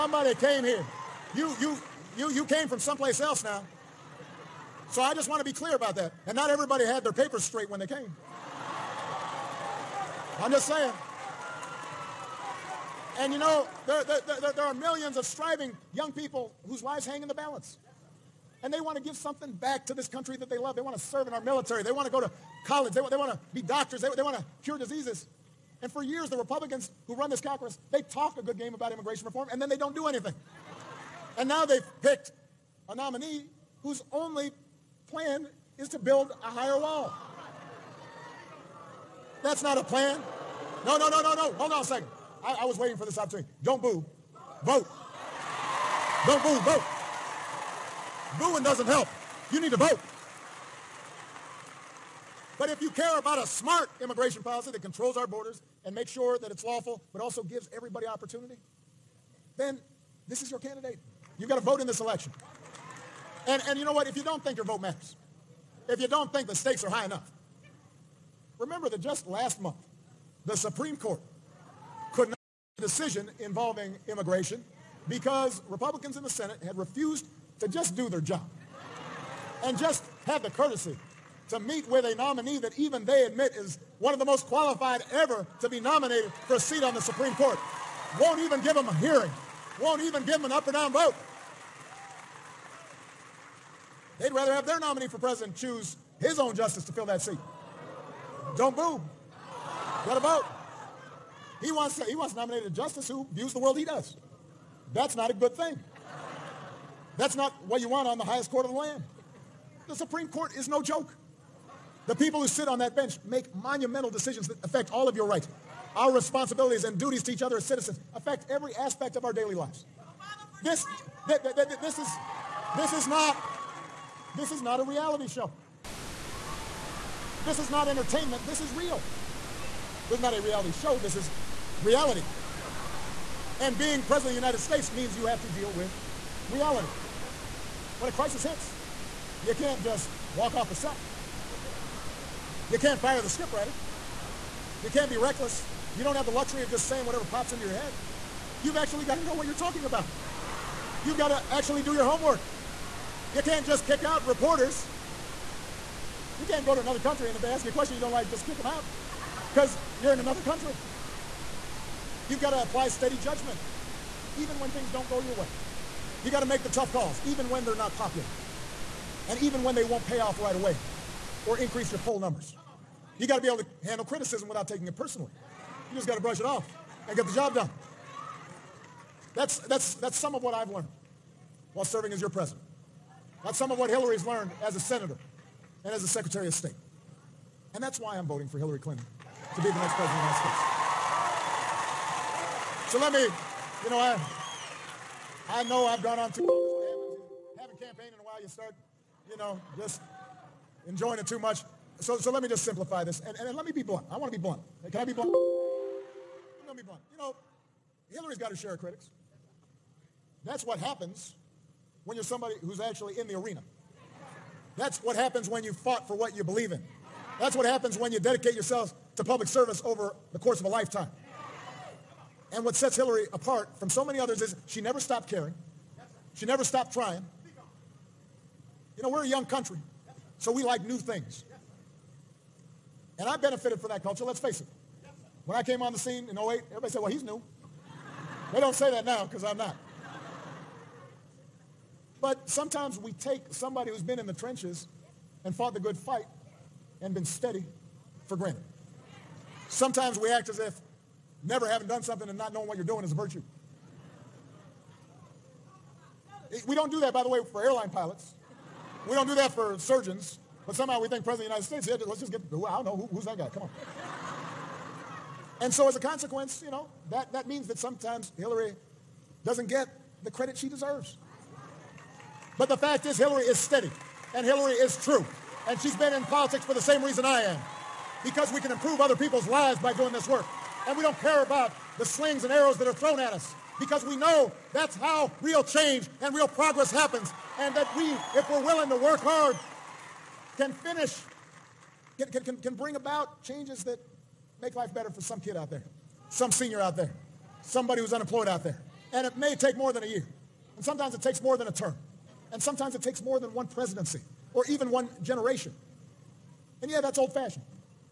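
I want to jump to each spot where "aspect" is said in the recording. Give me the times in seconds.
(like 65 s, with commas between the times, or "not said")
118 s.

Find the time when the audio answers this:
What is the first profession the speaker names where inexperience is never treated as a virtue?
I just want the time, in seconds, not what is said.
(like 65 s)
257 s.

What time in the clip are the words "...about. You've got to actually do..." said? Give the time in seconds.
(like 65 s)
149 s.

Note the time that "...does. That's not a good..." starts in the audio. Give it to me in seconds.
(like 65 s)
103 s.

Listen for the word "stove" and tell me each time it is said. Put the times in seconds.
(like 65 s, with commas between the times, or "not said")
not said.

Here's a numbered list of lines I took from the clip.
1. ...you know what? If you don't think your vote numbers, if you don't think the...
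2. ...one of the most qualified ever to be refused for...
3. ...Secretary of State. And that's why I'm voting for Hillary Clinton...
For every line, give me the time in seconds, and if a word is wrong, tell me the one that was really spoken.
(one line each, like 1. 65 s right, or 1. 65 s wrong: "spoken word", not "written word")
1. 63 s wrong: "matters", not "numbers"
2. 83 s wrong: "nominated", not "refused"
3. 186 s right.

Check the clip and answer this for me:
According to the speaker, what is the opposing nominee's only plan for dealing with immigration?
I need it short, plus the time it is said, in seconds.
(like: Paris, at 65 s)
build a higher wall, at 35 s.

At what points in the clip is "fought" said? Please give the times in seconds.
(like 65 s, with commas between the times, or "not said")
215 s, 245 s.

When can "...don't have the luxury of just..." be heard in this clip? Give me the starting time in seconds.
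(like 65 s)
146 s.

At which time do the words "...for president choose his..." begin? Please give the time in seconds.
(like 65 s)
95 s.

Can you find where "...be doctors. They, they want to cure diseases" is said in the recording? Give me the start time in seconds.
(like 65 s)
23 s.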